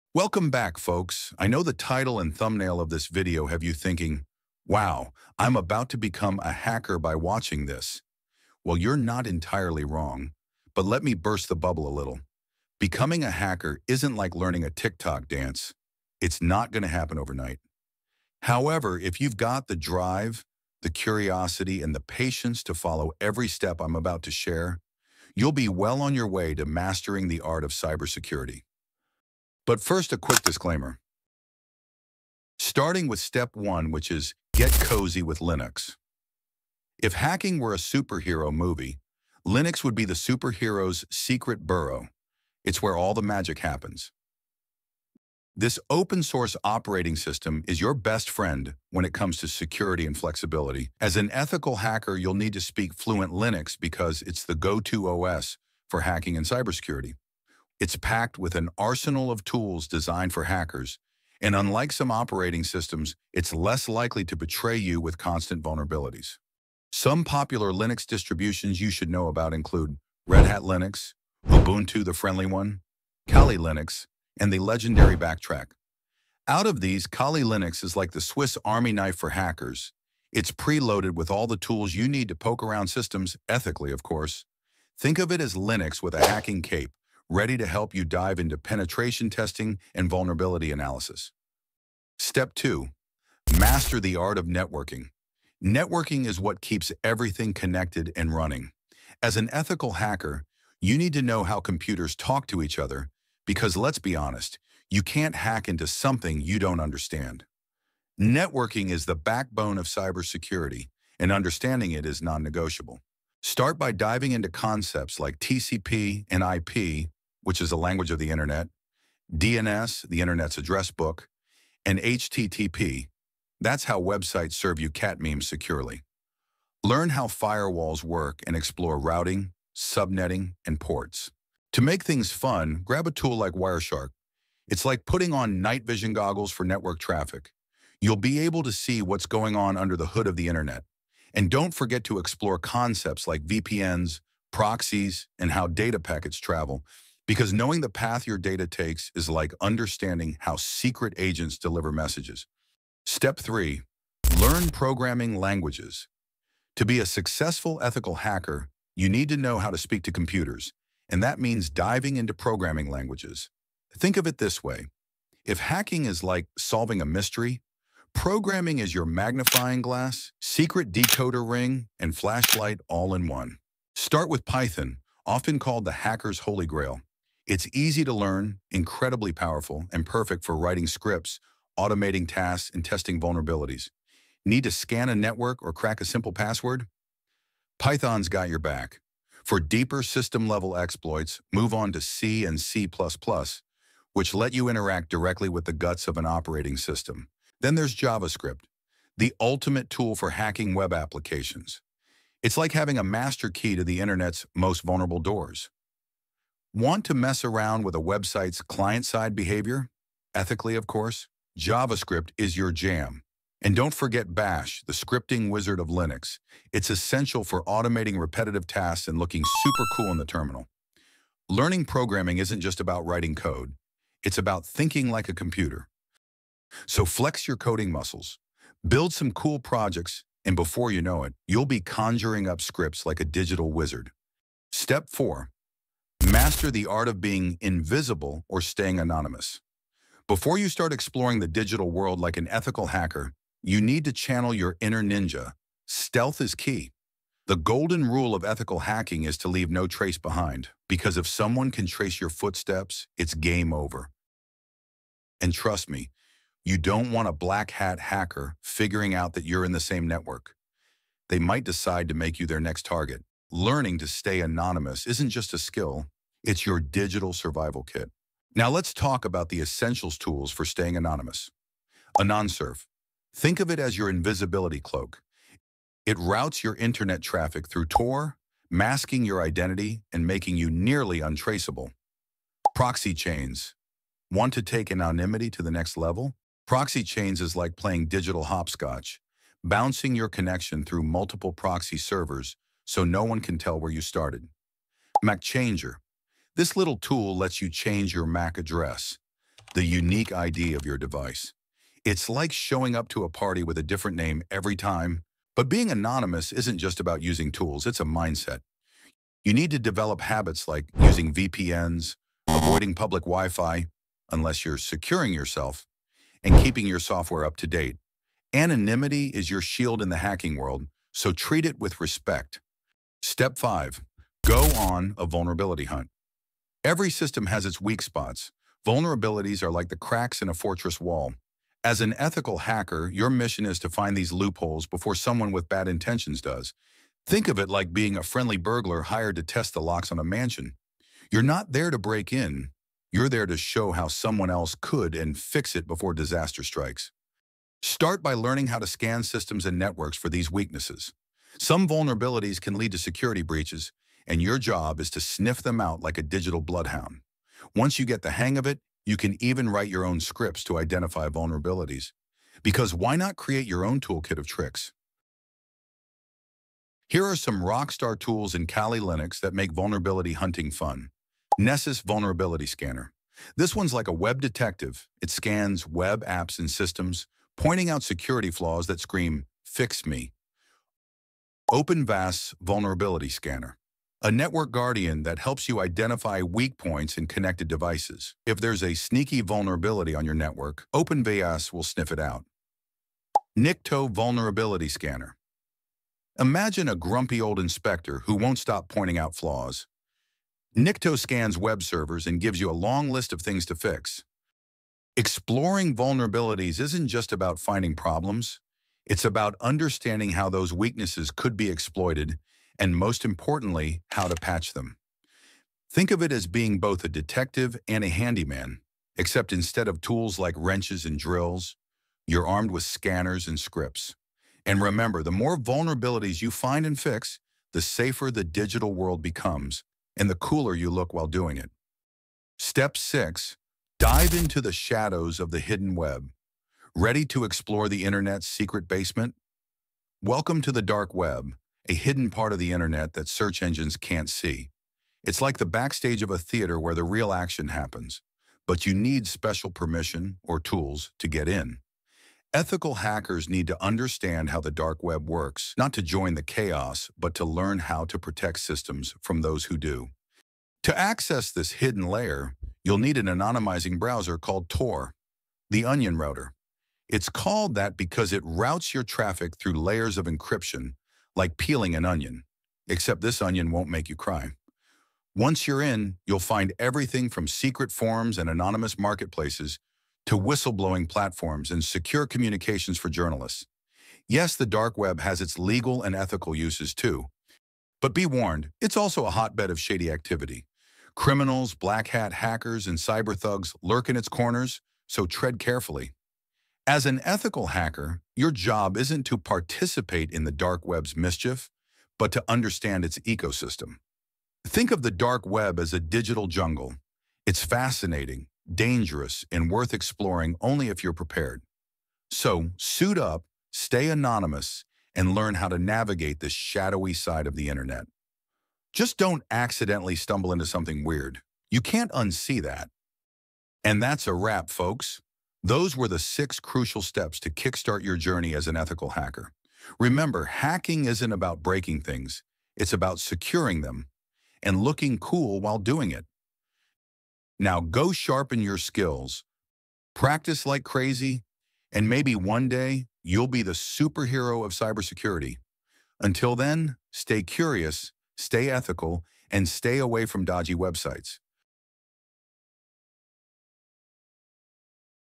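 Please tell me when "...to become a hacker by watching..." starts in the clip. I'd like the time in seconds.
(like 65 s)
5 s.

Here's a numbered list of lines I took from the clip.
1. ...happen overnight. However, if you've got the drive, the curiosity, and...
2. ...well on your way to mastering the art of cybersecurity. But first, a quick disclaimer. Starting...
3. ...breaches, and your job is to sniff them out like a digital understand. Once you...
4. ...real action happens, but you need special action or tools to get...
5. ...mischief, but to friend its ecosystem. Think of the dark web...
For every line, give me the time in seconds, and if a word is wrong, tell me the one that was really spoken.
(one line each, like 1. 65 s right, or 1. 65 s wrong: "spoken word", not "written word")
1. 16 s right
2. 25 s right
3. 353 s wrong: "bloodhound", not "understand"
4. 447 s wrong: "permission", not "action"
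5. 501 s wrong: "understand", not "friend".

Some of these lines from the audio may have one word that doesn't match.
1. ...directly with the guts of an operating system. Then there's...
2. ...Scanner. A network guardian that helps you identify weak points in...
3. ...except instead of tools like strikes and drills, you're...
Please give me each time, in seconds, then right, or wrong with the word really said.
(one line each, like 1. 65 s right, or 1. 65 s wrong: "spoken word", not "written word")
1. 195 s right
2. 383 s right
3. 419 s wrong: "wrenches", not "strikes".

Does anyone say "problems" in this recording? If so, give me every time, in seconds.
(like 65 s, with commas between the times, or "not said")
407 s.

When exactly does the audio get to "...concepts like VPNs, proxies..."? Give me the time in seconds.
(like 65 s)
142 s.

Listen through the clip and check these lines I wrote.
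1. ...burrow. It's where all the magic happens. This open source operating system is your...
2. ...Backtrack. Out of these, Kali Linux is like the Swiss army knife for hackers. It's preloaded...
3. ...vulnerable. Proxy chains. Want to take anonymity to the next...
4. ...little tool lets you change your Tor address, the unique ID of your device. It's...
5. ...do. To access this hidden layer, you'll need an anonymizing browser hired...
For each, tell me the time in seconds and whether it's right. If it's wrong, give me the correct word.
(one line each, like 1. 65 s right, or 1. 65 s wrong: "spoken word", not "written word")
1. 41 s right
2. 75 s right
3. 281 s wrong: "untraceable", not "vulnerable"
4. 296 s wrong: "MAC", not "Tor"
5. 459 s wrong: "called", not "hired".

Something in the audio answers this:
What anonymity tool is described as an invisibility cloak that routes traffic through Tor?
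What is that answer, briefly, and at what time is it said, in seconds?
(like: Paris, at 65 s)
AnonSurf, at 272 s.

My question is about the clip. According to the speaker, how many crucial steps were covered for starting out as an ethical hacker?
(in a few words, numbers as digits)
6.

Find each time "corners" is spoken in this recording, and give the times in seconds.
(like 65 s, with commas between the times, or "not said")
494 s.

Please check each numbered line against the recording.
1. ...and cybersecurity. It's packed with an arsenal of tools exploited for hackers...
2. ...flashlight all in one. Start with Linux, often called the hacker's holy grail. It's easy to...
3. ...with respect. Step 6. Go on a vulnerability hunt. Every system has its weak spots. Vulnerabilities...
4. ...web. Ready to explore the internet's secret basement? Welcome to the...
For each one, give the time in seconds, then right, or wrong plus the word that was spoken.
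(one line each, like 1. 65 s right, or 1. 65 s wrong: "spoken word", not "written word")
1. 56 s wrong: "designed", not "exploited"
2. 172 s wrong: "Python", not "Linux"
3. 321 s wrong: "5", not "6"
4. 435 s right.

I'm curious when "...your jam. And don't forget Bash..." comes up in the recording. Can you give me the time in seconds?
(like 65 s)
212 s.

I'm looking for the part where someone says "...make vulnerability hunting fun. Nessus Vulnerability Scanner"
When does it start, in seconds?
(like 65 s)
369 s.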